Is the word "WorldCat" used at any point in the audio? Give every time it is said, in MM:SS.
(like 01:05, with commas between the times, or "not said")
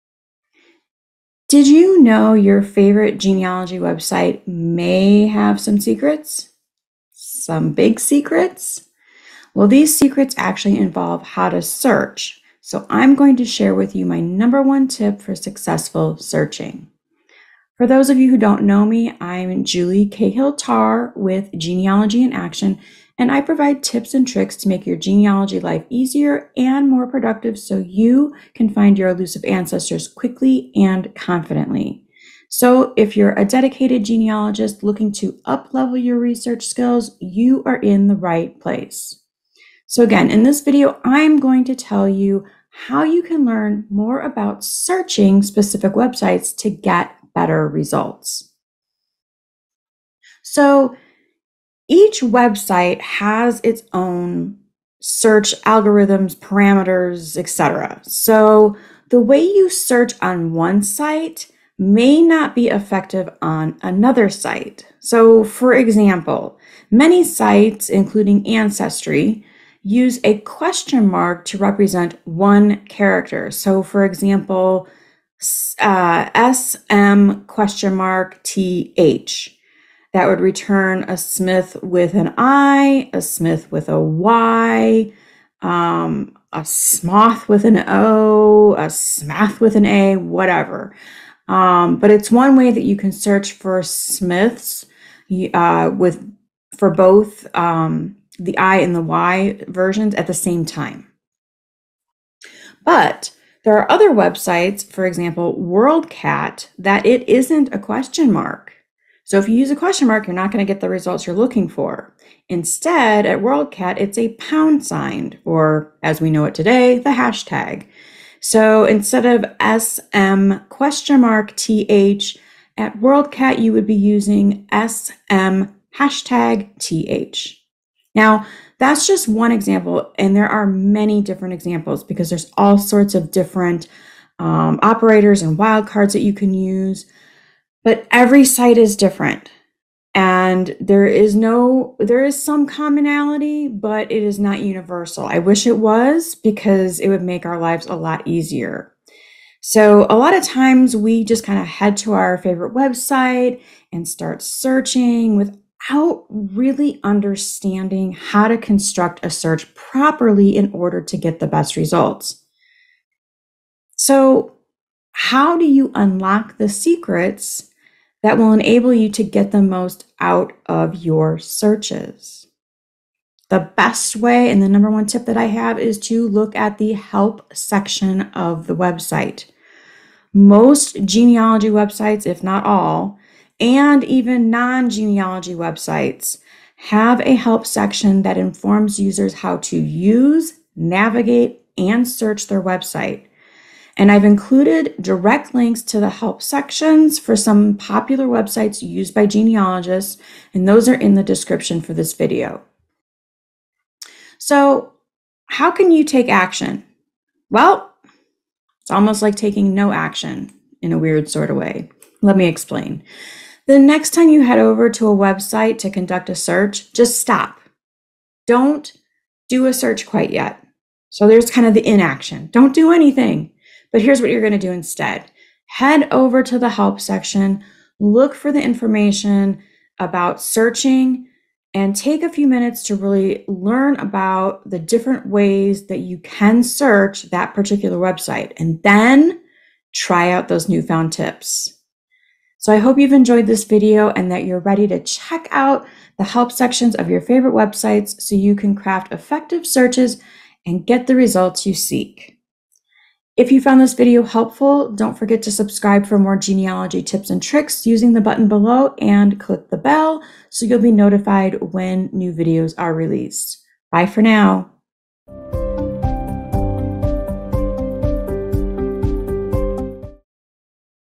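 01:45, 01:53, 02:02.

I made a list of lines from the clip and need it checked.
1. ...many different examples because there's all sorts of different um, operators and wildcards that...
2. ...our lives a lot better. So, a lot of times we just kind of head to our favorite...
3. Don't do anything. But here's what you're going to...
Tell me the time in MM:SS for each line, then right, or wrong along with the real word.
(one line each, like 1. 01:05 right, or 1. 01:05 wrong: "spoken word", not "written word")
1. 02:10 right
2. 02:27 wrong: "easier", not "better"
3. 03:42 right.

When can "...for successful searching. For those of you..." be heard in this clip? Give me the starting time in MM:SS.
00:15.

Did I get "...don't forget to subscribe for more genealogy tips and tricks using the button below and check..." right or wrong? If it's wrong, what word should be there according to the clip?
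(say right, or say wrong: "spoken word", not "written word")
wrong: "click", not "check".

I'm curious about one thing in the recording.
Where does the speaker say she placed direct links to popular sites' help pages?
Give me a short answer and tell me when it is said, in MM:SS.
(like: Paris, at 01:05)
the description, at 03:20.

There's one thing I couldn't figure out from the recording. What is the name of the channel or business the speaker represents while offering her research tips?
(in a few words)
Genealogy in Action.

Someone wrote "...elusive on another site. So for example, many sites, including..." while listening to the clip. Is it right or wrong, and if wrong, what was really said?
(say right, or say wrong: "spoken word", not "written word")
wrong: "effective", not "elusive".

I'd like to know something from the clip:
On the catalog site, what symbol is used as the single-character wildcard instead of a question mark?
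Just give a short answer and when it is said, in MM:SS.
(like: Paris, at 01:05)
pound sign, at 01:54.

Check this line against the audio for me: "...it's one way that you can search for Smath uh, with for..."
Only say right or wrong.
wrong.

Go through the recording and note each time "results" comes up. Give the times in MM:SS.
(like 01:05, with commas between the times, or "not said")
00:47, 01:50, 02:41, 04:11.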